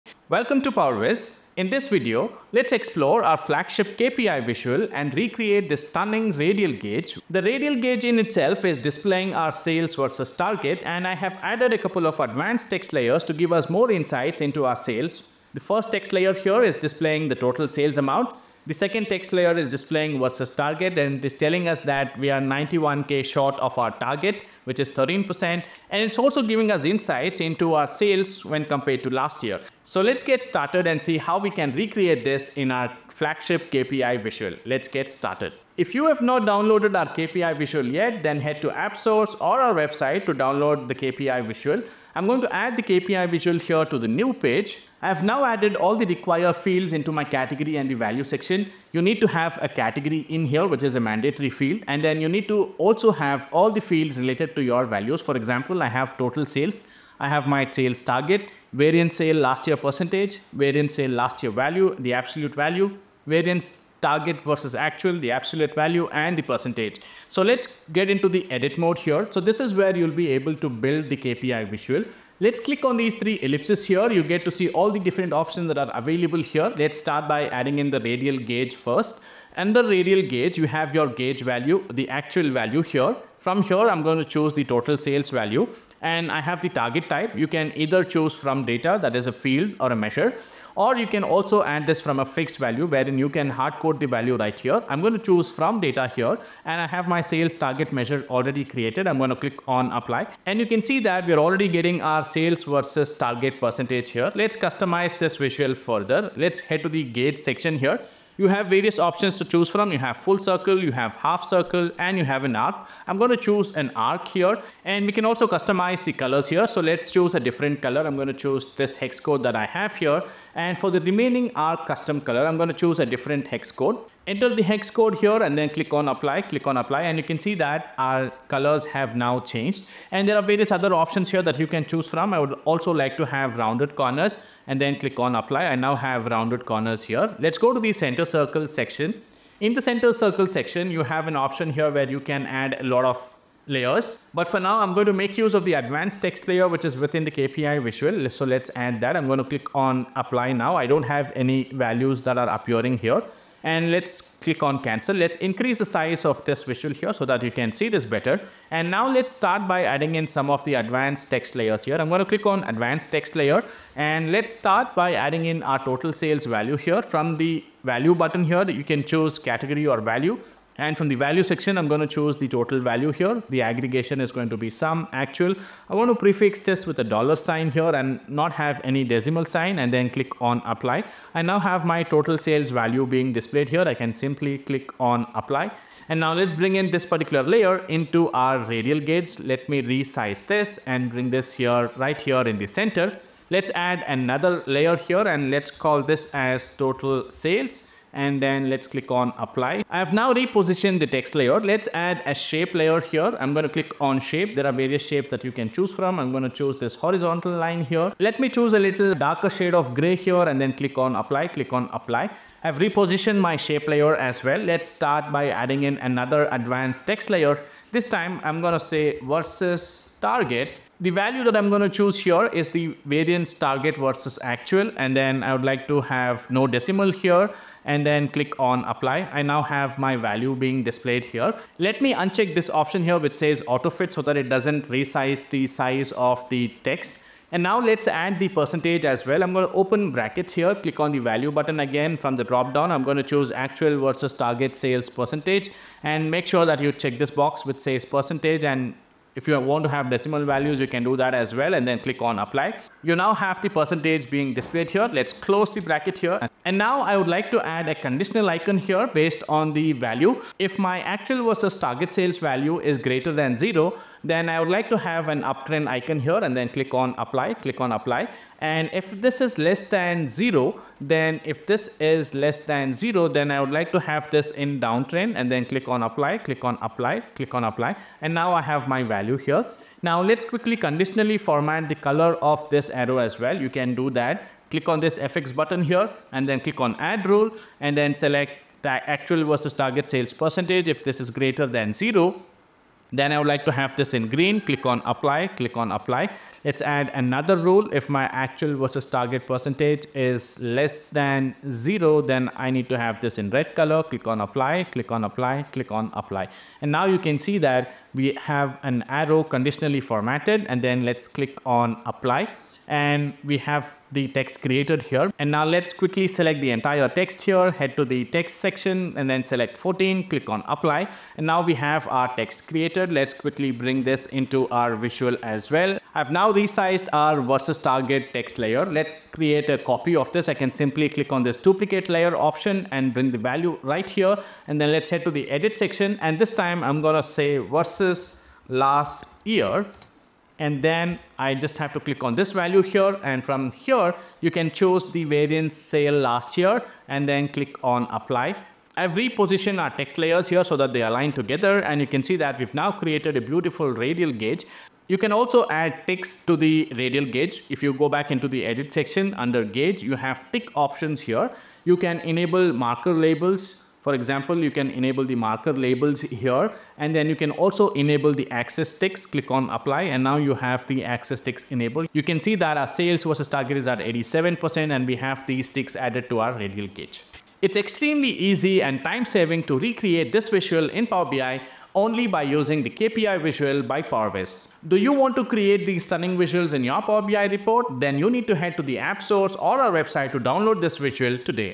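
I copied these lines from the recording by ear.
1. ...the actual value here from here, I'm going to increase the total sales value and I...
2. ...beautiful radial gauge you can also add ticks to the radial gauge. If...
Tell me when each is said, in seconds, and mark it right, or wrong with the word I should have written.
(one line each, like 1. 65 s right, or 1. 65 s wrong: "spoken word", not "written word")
1. 81 s wrong: "choose", not "increase"
2. 353 s right.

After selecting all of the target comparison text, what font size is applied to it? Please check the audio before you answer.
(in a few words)
14.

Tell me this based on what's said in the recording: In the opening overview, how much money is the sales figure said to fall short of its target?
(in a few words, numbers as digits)
91k.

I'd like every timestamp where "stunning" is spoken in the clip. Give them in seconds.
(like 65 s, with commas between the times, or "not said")
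5 s, 386 s.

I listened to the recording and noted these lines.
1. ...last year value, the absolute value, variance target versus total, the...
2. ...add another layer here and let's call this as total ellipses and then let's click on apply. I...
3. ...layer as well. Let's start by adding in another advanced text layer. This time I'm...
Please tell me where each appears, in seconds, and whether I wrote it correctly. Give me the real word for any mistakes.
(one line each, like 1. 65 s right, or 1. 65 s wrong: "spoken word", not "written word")
1. 61 s wrong: "actual", not "total"
2. 193 s wrong: "sales", not "ellipses"
3. 213 s right.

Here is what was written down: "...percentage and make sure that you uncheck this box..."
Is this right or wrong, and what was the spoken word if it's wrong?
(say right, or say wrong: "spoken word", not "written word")
wrong: "check", not "uncheck".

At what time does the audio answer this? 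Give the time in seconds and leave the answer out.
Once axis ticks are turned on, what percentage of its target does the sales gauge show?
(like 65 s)
373 s.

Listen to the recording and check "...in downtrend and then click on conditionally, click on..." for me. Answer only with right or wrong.
wrong.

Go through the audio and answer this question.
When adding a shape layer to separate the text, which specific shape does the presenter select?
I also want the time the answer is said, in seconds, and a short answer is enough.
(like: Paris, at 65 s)
horizontal line, at 206 s.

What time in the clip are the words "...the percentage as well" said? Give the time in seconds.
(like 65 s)
238 s.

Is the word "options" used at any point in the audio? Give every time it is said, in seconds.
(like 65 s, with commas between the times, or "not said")
75 s, 108 s, 130 s, 141 s, 232 s, 332 s, 360 s.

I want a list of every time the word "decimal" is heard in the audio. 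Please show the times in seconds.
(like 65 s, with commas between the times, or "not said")
179 s, 226 s, 250 s.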